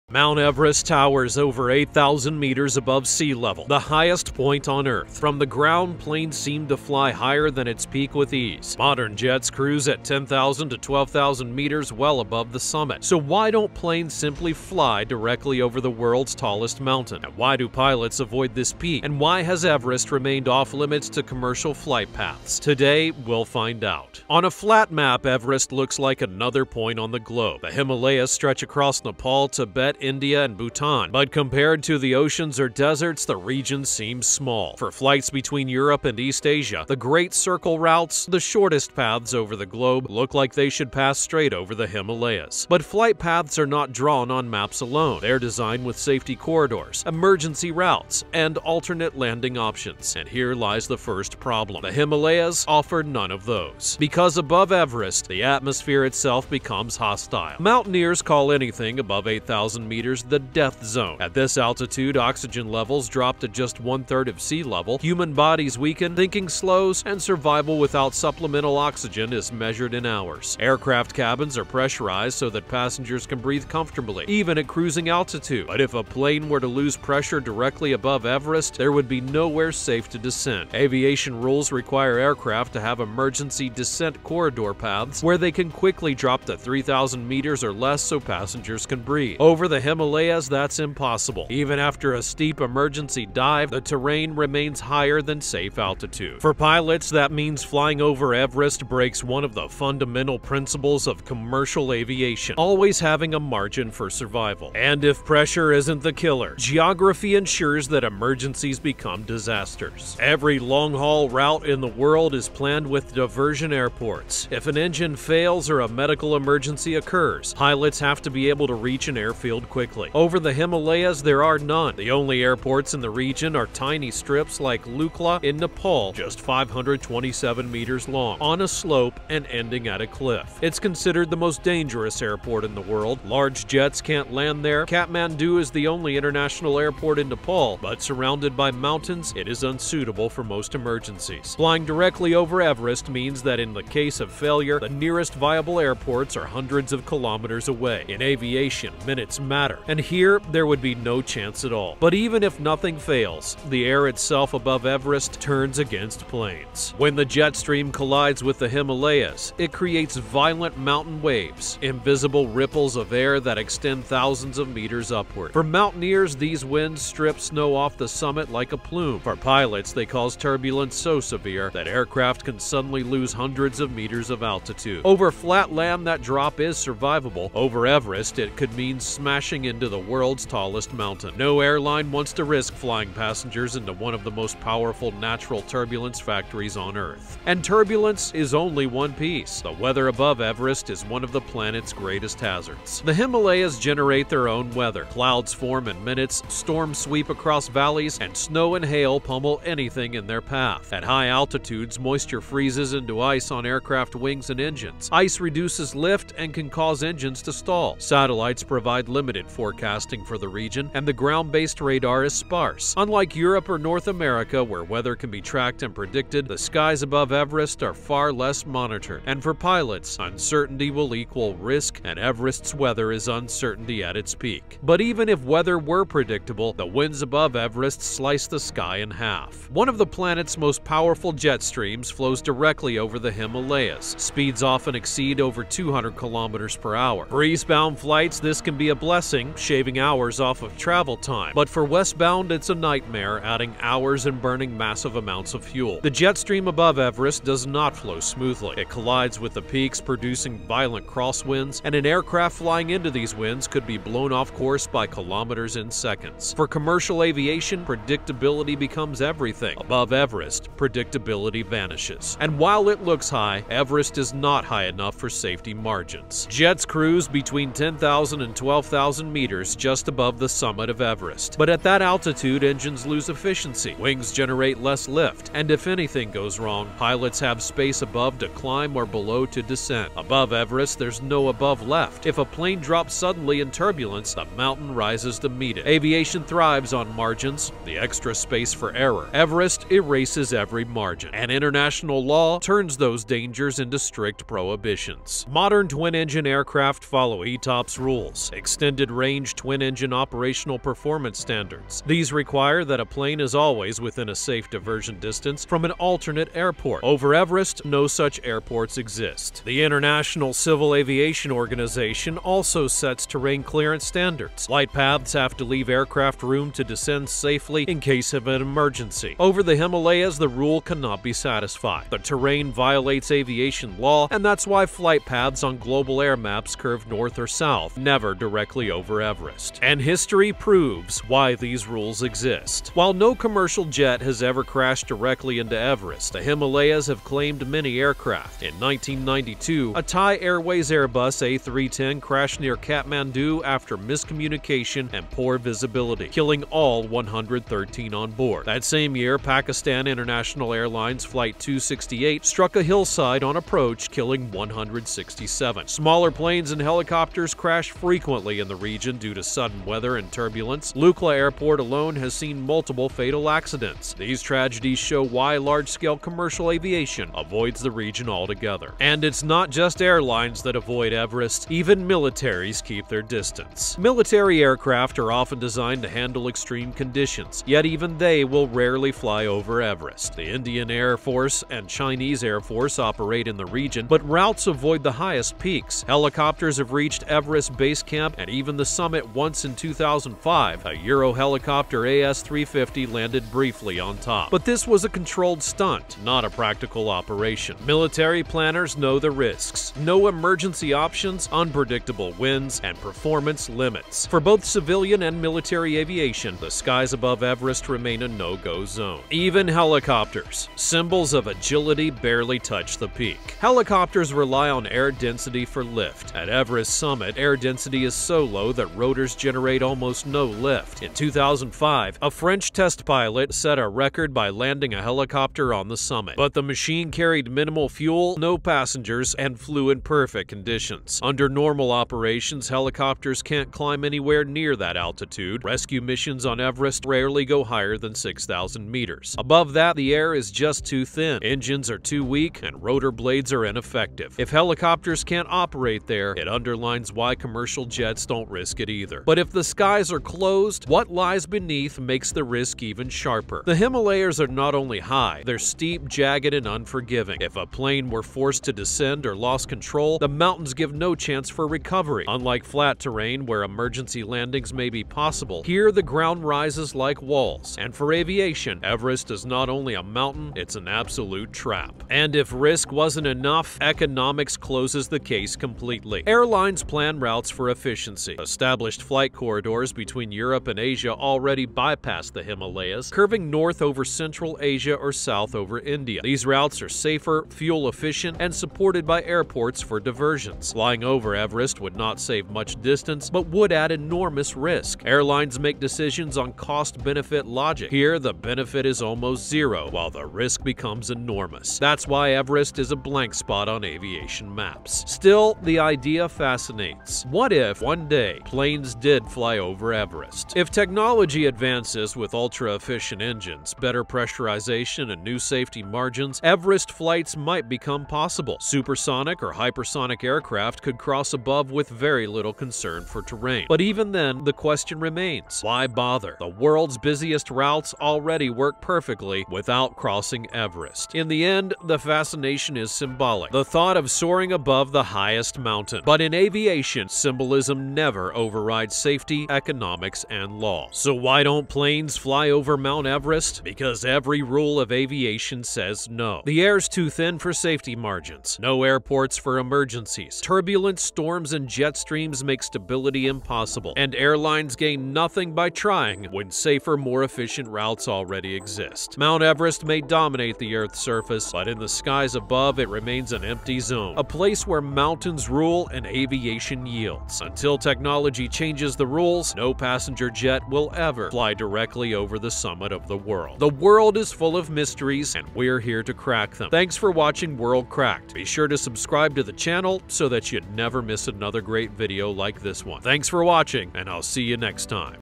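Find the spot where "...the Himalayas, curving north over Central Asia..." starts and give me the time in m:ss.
8:02.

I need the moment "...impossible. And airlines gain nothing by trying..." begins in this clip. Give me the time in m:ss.
9:13.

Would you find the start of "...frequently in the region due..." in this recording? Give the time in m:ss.
5:57.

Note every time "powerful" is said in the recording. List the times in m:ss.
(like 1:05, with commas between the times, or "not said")
3:04, 3:50.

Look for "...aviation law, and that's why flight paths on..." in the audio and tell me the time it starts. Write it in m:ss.
5:23.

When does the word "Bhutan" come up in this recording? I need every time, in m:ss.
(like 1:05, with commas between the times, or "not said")
0:30.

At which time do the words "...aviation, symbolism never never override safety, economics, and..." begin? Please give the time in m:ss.
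8:56.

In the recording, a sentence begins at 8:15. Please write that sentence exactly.
Airlines make decisions on cost-benefit logic.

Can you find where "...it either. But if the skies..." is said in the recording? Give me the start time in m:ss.
7:28.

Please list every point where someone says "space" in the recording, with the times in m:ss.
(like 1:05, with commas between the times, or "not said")
4:37, 4:48.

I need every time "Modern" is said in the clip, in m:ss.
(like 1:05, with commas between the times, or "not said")
0:08, 4:55.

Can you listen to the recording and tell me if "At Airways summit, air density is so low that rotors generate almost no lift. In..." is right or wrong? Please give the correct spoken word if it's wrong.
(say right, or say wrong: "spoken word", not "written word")
wrong: "Everest", not "Airways".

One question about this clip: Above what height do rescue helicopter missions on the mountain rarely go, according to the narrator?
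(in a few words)
6,000 meters.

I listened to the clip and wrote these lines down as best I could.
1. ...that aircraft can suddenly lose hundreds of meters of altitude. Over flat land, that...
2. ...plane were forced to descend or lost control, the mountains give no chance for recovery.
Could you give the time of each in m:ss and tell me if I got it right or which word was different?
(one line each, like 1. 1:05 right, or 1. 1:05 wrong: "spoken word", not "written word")
1. 2:51 right
2. 7:37 right.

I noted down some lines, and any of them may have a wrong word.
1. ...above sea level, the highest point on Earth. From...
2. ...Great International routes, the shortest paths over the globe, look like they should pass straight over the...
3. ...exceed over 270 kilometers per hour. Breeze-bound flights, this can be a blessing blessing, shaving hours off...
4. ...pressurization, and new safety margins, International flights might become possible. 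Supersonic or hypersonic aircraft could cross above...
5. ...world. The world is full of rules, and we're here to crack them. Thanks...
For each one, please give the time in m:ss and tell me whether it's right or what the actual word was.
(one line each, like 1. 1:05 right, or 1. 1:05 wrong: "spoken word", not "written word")
1. 0:02 right
2. 0:36 wrong: "Circle", not "International"
3. 3:54 wrong: "200", not "270"
4. 8:34 wrong: "Everest", not "International"
5. 9:33 wrong: "mysteries", not "rules".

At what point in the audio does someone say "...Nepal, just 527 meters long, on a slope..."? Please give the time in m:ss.
2:05.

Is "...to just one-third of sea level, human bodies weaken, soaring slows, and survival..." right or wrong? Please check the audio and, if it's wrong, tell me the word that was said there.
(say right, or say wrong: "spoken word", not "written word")
wrong: "thinking", not "soaring".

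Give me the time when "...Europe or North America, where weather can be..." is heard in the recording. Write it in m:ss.
3:33.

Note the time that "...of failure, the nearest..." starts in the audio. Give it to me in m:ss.
2:24.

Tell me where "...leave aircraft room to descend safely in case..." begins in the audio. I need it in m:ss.
5:15.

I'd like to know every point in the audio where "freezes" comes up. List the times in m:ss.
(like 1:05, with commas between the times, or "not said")
3:22.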